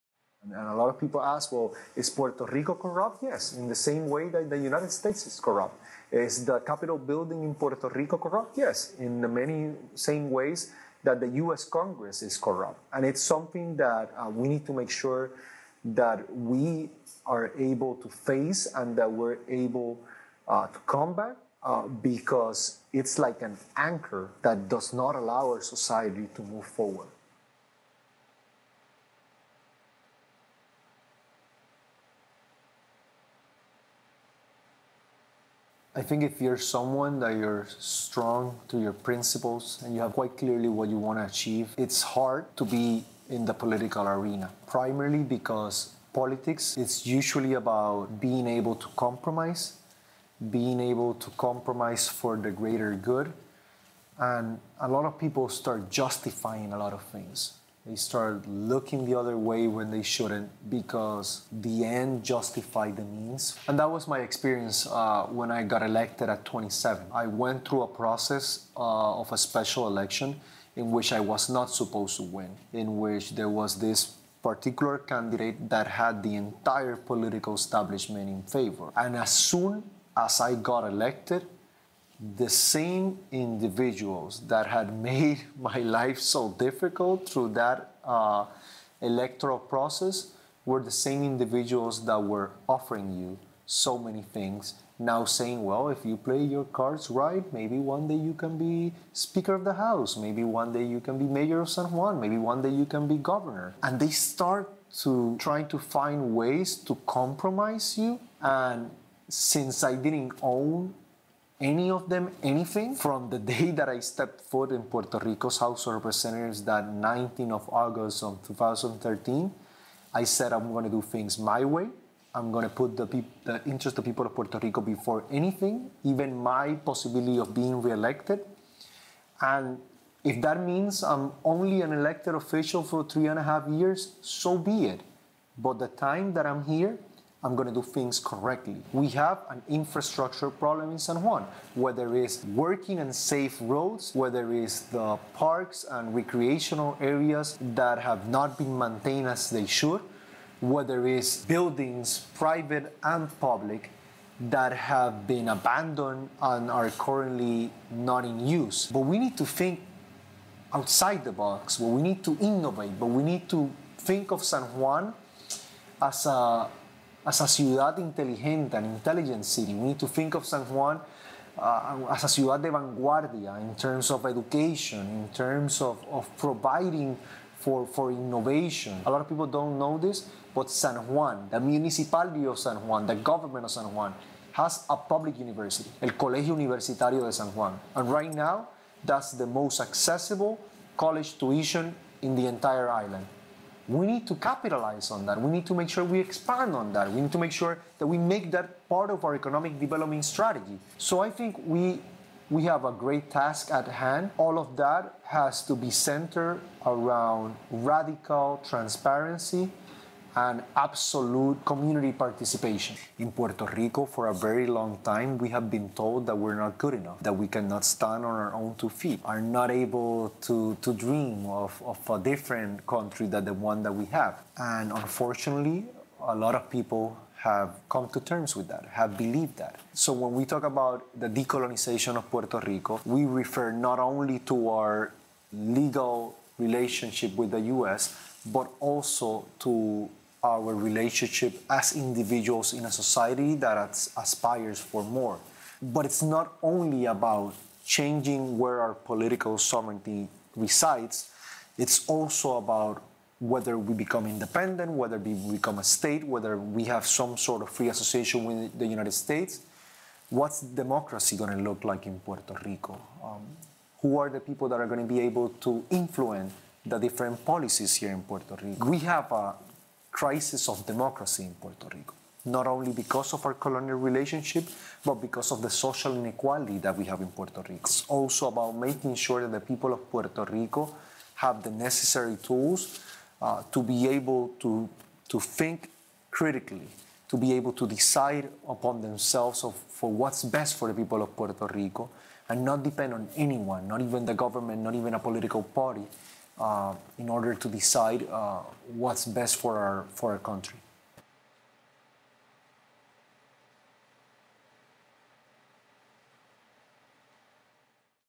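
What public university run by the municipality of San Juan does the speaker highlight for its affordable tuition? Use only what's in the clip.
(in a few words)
Colegio Universitario de San Juan.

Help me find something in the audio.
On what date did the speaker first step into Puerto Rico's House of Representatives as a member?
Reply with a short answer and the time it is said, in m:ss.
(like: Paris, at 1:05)
August 19, 2013, at 1:56.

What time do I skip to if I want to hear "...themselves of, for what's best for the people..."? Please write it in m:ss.
4:49.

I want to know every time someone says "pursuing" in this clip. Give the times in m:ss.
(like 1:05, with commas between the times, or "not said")
not said.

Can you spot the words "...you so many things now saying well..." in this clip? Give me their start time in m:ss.
1:33.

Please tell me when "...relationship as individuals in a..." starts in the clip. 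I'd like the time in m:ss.
4:00.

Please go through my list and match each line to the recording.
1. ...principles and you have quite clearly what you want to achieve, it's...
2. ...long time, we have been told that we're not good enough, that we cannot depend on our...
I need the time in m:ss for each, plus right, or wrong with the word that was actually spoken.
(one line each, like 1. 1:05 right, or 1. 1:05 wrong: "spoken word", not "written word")
1. 0:38 right
2. 3:34 wrong: "stand", not "depend".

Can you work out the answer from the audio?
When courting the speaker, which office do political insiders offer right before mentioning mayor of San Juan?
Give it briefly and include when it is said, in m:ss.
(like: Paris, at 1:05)
speaker of the house, at 1:39.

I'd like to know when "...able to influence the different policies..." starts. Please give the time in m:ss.
4:25.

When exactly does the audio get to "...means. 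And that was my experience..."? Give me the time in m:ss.
1:03.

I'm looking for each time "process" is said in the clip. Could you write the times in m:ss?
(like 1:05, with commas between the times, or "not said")
1:07, 1:29.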